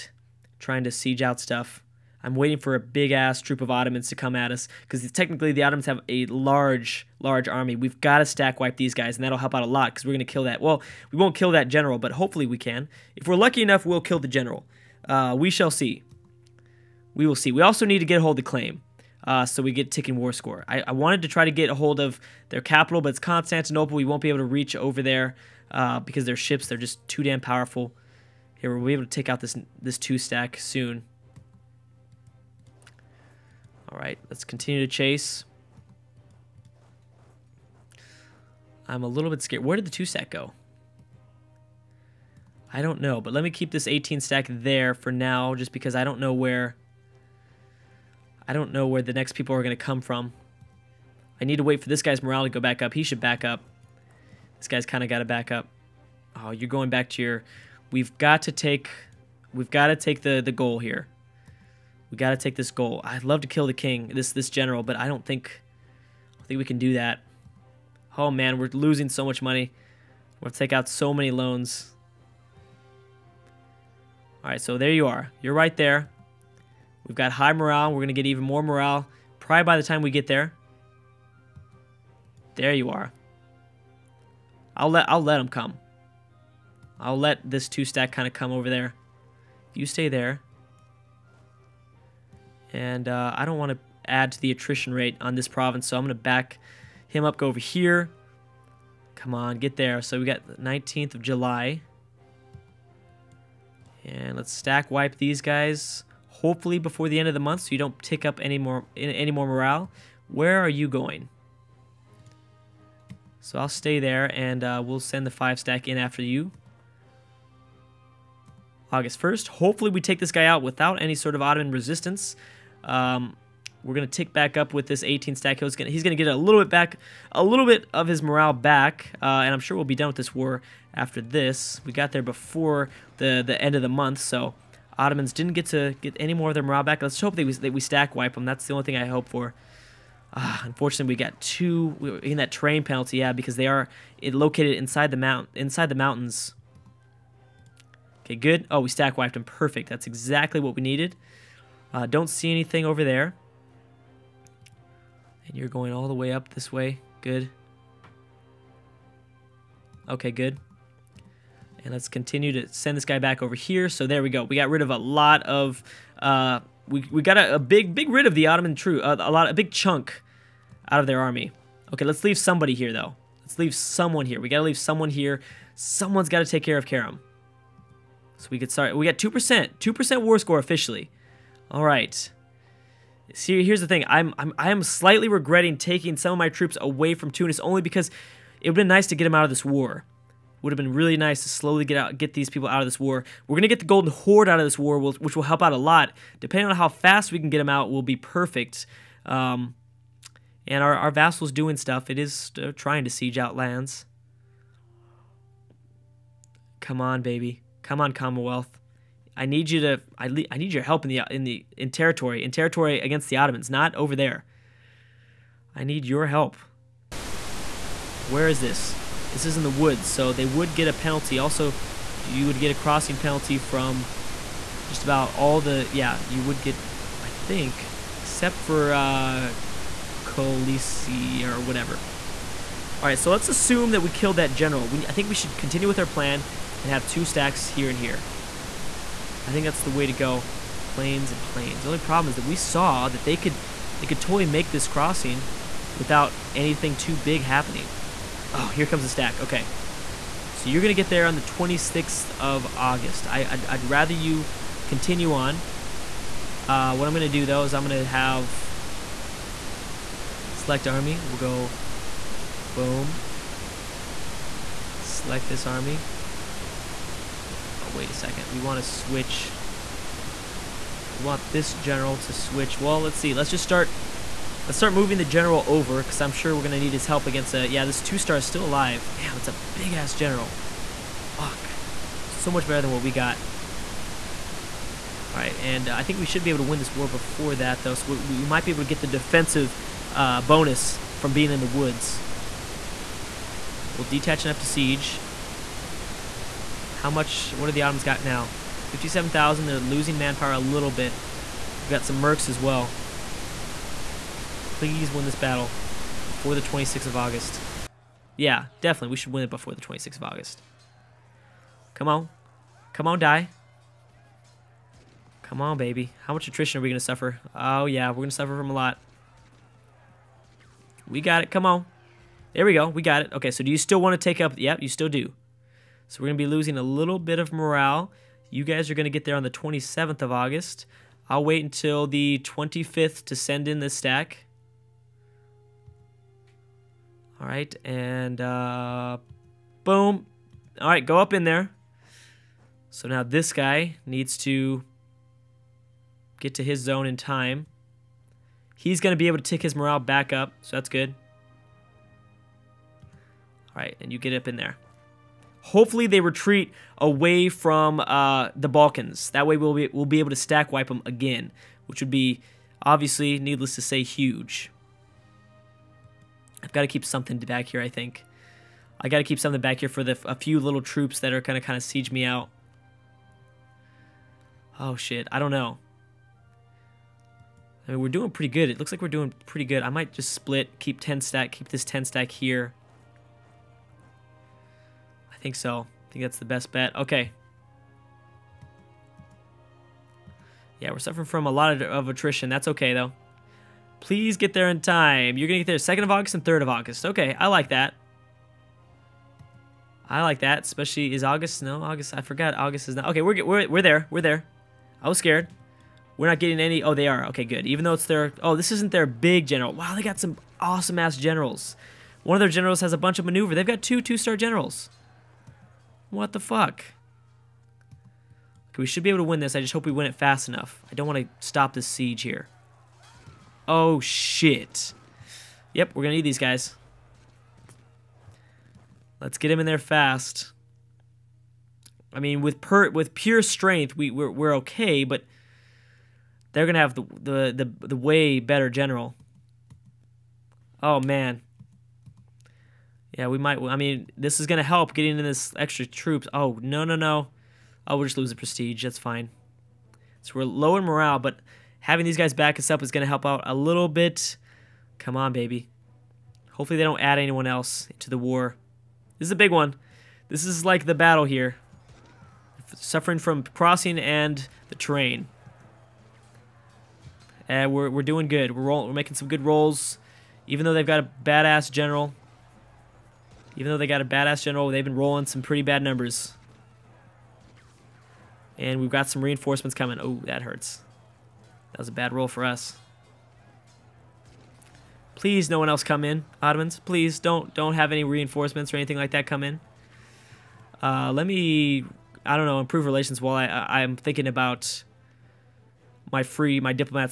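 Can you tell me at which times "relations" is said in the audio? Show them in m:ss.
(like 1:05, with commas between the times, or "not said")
8:12.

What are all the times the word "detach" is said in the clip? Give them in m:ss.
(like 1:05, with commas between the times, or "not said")
4:54.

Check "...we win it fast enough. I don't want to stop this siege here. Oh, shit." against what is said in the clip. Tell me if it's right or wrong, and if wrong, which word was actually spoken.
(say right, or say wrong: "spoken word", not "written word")
right.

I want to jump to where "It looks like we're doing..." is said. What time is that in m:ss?
6:18.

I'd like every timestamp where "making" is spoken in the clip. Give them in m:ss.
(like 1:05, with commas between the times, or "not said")
7:48.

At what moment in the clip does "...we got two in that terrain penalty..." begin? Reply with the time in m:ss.
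2:21.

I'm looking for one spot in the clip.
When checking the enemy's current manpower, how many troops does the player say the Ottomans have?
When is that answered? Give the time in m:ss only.
4:58.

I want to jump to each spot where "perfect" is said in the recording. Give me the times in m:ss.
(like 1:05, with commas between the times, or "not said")
2:29, 3:18.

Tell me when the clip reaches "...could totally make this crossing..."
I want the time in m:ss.
4:04.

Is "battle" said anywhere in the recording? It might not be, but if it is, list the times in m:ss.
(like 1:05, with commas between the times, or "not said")
5:05, 7:40.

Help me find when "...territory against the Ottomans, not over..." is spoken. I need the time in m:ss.
3:32.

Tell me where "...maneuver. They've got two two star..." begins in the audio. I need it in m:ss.
6:53.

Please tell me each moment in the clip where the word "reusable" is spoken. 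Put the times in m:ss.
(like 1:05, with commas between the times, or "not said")
not said.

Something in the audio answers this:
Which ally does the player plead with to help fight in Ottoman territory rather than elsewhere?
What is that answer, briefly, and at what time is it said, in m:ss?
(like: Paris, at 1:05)
Commonwealth, at 3:28.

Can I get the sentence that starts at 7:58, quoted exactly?
And we've got some reinforcements coming.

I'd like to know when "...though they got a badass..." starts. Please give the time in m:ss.
7:53.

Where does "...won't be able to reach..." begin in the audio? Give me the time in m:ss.
0:24.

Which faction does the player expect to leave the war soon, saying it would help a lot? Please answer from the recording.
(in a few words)
Golden Horde.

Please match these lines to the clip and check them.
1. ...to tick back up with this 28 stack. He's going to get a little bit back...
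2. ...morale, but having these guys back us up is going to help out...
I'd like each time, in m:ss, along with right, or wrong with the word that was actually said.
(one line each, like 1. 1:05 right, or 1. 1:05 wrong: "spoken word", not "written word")
1. 2:04 wrong: "18", not "28"
2. 7:30 right.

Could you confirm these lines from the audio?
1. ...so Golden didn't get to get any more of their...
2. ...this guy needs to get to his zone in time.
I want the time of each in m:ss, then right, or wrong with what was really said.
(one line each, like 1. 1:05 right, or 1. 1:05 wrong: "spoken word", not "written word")
1. 2:14 wrong: "Ottomans", not "Golden"
2. 5:43 right.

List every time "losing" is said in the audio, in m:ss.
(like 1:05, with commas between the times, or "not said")
1:08, 4:59, 5:26.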